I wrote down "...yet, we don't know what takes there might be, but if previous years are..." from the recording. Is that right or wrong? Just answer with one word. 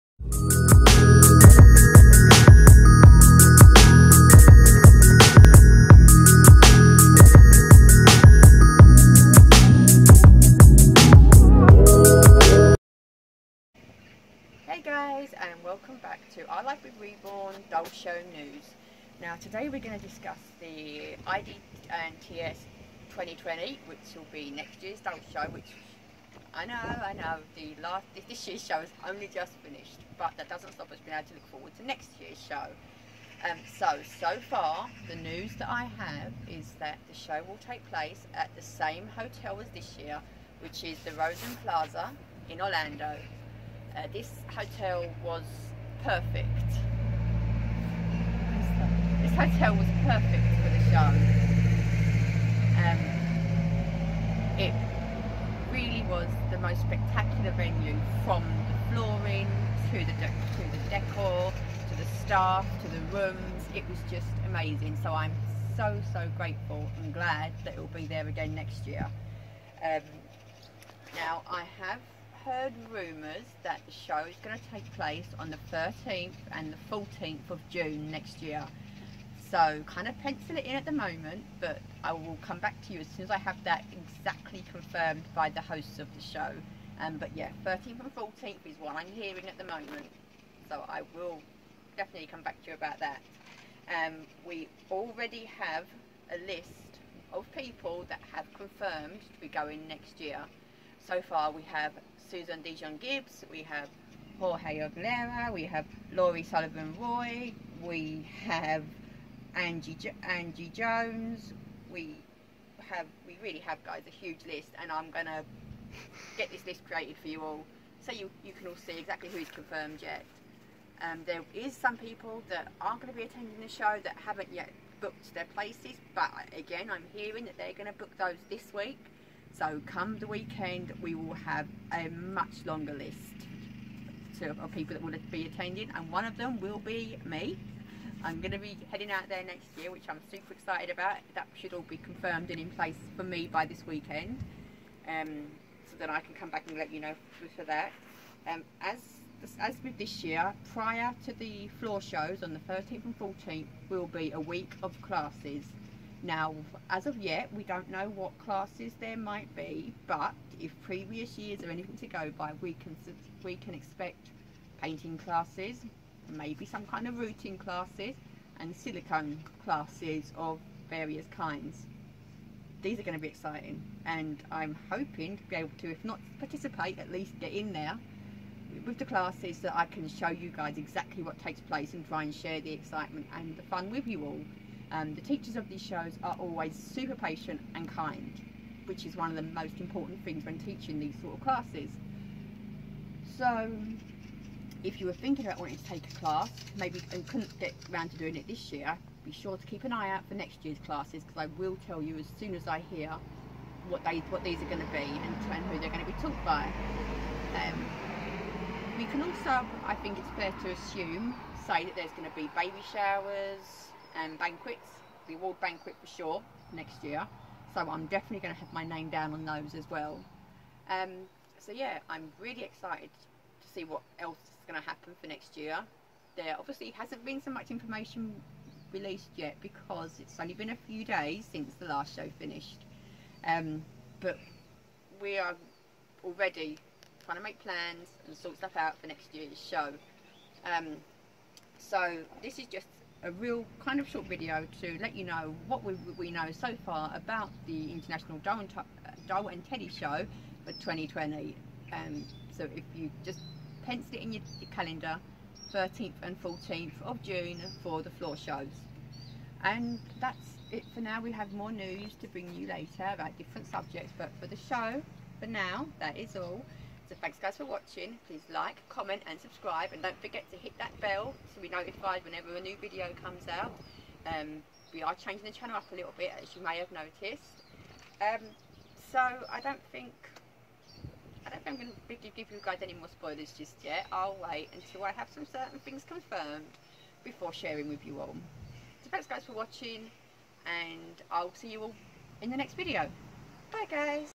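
wrong.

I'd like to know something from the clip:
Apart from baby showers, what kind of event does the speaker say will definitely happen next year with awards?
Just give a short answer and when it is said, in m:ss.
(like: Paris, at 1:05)
Award banquet, at 3:35.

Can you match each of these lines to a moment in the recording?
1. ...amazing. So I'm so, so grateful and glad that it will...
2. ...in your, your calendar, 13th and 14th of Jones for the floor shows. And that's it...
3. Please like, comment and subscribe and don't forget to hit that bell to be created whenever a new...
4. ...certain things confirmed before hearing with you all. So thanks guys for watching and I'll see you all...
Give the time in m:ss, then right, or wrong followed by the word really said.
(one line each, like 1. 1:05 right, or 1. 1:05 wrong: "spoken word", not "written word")
1. 1:04 right
2. 4:14 wrong: "June", not "Jones"
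3. 4:28 wrong: "notified", not "created"
4. 4:45 wrong: "sharing", not "hearing".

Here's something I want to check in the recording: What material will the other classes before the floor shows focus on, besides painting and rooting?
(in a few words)
Silicone.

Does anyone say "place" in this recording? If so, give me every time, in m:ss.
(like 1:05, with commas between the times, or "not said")
0:37, 1:14, 2:05, 2:22, 3:01.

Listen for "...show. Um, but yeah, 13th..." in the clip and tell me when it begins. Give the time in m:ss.
1:26.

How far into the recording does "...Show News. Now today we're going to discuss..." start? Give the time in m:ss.
0:17.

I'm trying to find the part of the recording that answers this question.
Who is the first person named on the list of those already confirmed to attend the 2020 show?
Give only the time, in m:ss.
1:42.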